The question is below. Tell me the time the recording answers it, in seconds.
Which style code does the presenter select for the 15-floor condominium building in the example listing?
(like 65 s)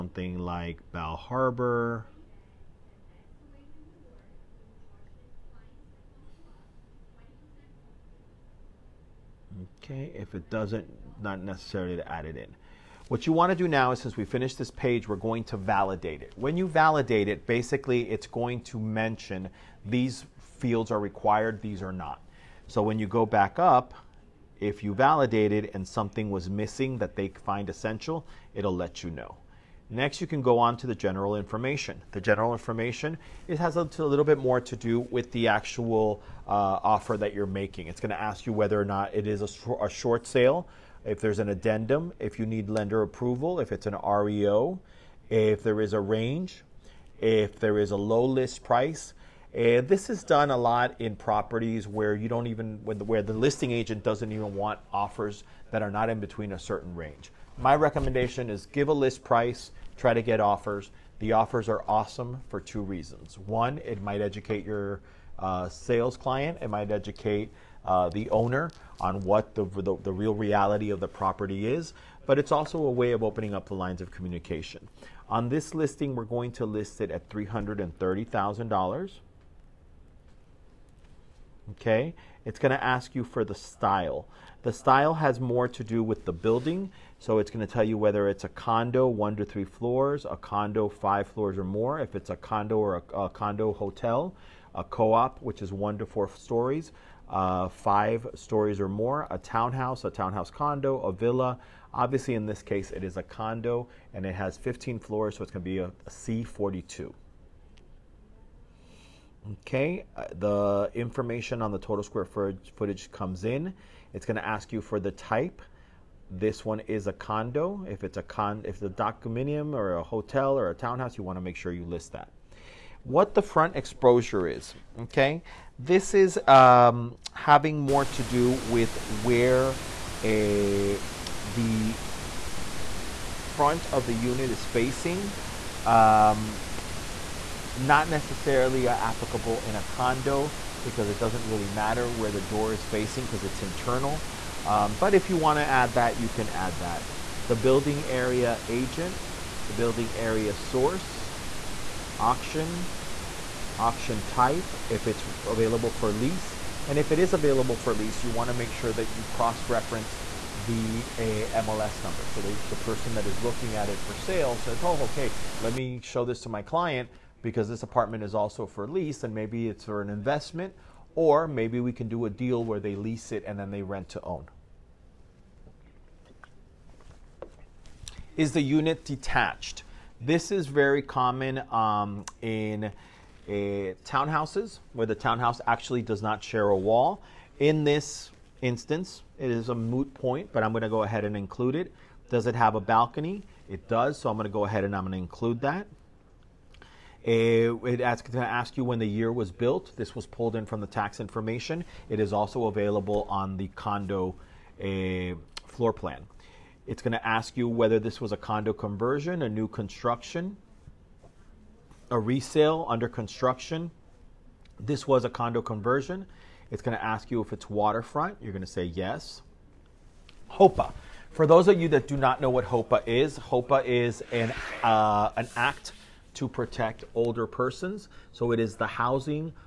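106 s.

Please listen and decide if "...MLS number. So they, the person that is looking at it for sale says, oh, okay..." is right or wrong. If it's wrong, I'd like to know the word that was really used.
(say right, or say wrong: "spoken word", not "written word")
right.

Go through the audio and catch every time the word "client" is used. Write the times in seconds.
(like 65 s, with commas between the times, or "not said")
66 s, 166 s.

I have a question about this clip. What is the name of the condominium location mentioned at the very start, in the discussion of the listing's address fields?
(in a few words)
Bal Harbor.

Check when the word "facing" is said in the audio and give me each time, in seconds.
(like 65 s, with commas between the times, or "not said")
134 s, 142 s.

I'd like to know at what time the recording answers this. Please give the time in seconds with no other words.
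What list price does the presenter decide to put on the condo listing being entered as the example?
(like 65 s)
77 s.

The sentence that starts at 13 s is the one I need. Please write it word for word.
What you want to do now is since we finished this page, we're going to validate it.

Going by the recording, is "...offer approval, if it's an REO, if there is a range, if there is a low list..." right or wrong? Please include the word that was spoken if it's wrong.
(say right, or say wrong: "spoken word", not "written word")
wrong: "lender", not "offer".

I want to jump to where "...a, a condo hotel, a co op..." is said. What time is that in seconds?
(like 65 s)
93 s.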